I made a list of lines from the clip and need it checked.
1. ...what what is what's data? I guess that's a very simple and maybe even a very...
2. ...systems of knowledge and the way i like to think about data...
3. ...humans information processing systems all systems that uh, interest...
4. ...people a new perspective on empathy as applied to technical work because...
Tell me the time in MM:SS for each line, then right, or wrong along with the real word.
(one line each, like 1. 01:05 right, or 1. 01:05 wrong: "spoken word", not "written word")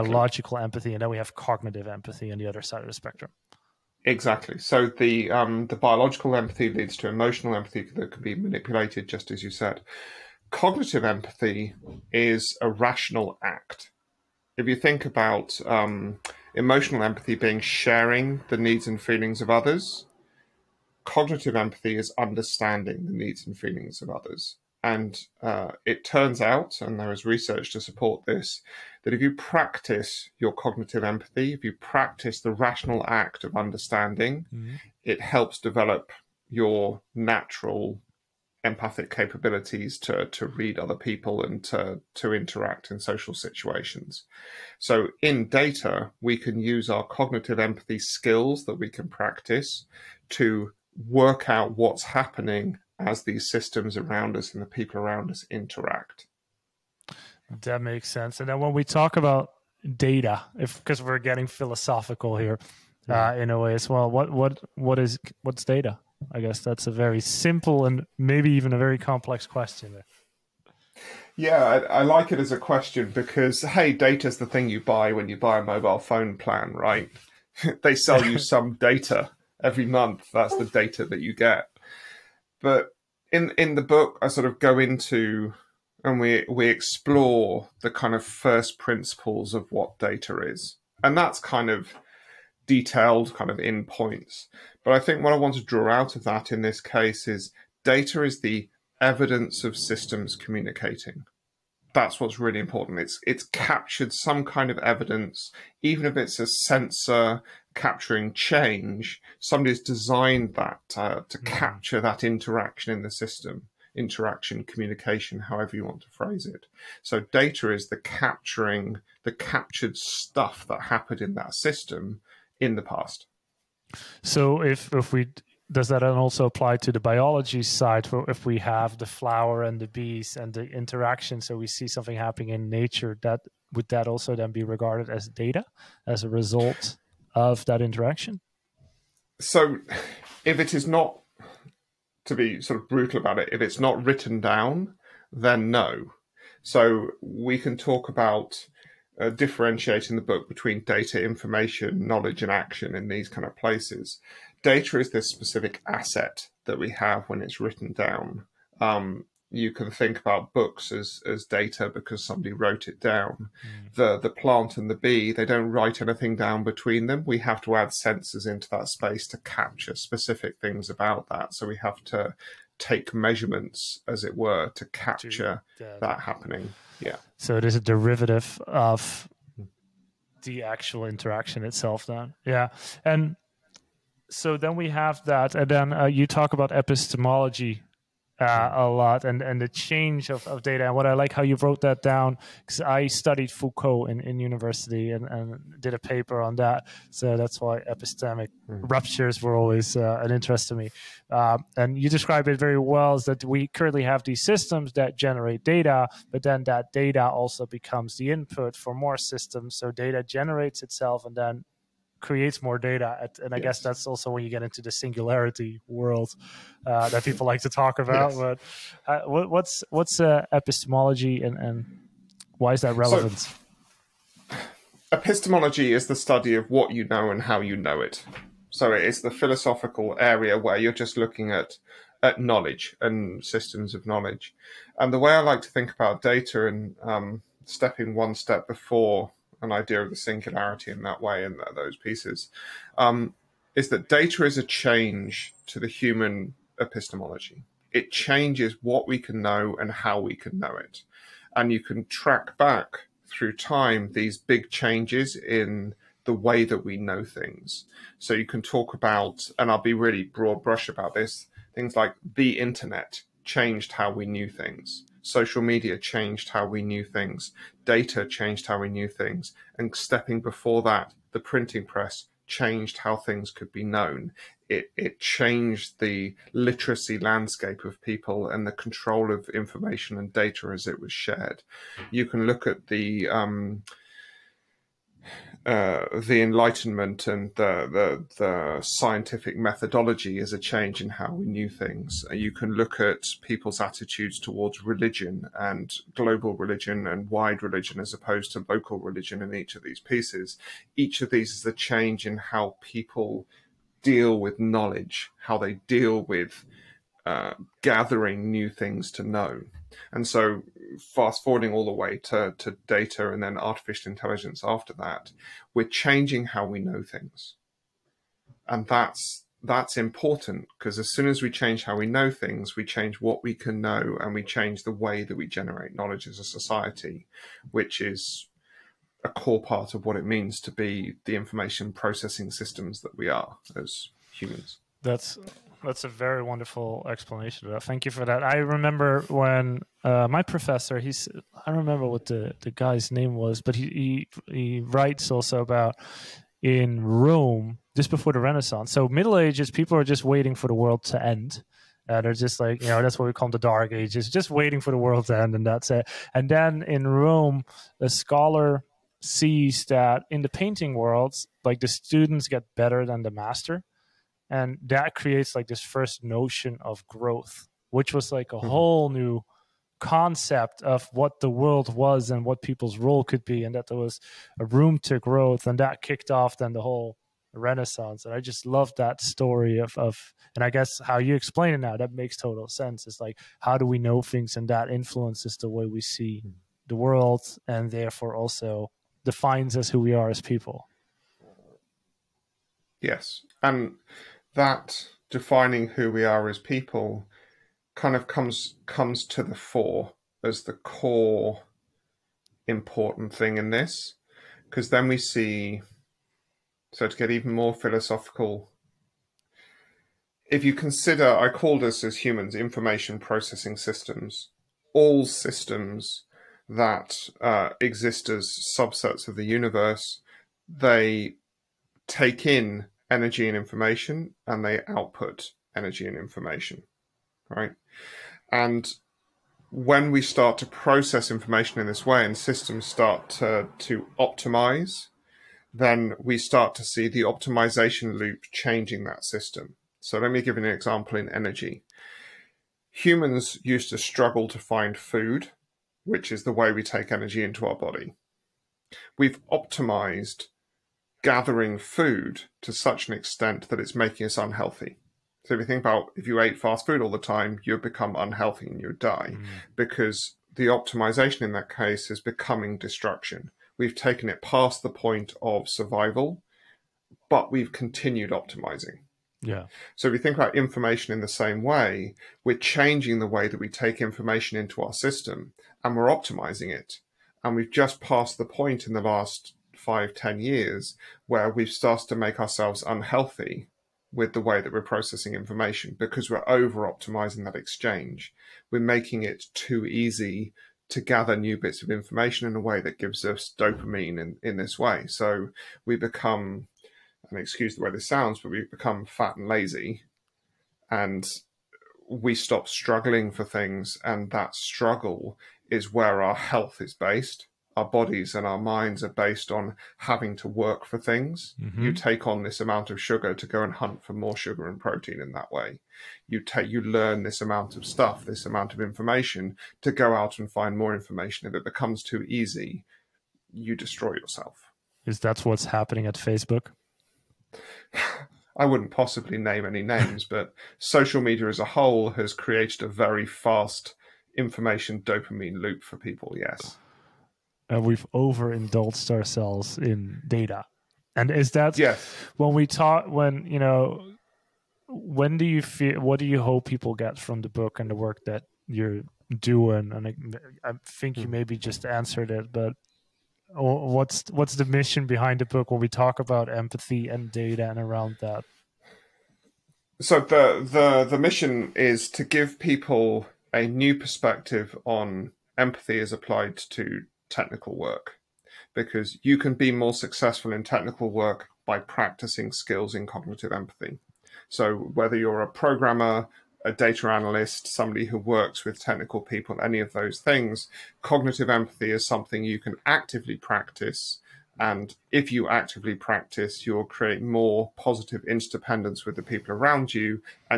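1. 01:04 right
2. 03:53 right
3. 06:52 wrong: "exist", not "interest"
4. 09:22 right.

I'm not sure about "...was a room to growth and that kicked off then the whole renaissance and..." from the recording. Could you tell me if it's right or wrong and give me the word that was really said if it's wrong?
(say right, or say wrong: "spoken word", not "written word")
right.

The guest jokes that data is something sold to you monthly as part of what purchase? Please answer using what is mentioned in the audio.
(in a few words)
mobile phone plan.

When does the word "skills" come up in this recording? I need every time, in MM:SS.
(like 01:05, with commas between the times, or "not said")
00:47, 09:32.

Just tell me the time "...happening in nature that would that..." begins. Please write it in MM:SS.
02:12.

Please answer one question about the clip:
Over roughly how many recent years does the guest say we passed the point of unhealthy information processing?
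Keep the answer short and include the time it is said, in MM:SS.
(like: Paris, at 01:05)
5 to 10 years, at 07:59.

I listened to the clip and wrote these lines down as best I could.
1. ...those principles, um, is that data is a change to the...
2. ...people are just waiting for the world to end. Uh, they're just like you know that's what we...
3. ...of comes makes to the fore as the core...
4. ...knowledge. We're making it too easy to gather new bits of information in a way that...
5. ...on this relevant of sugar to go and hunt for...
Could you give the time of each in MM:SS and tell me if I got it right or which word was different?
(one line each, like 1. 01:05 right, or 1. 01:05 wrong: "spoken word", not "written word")
1. 04:01 wrong: "pieces", not "principles"
2. 05:49 right
3. 06:38 wrong: "comes", not "makes"
4. 08:07 wrong: "exchange", not "knowledge"
5. 08:32 wrong: "amount", not "relevant".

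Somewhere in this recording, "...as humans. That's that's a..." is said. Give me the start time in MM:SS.
05:33.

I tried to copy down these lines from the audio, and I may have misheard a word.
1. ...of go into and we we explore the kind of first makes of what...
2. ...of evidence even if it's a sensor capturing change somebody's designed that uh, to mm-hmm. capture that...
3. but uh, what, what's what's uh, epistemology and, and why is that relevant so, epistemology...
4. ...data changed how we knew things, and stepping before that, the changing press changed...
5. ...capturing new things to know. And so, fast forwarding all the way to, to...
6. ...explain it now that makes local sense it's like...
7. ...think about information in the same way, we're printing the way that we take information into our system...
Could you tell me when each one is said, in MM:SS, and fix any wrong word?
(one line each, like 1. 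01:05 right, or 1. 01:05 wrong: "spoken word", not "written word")
1. 01:24 wrong: "principles", not "makes"
2. 01:44 right
3. 03:38 right
4. 04:27 wrong: "printing", not "changing"
5. 05:07 wrong: "gathering", not "capturing"
6. 06:21 wrong: "total", not "local"
7. 07:50 wrong: "changing", not "printing".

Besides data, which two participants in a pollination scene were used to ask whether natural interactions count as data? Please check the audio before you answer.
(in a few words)
the flower and the bees.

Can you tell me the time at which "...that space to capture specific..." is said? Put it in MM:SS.
02:48.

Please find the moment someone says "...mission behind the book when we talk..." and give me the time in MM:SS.
09:14.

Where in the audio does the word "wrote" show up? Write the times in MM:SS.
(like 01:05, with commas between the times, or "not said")
02:42, 03:11.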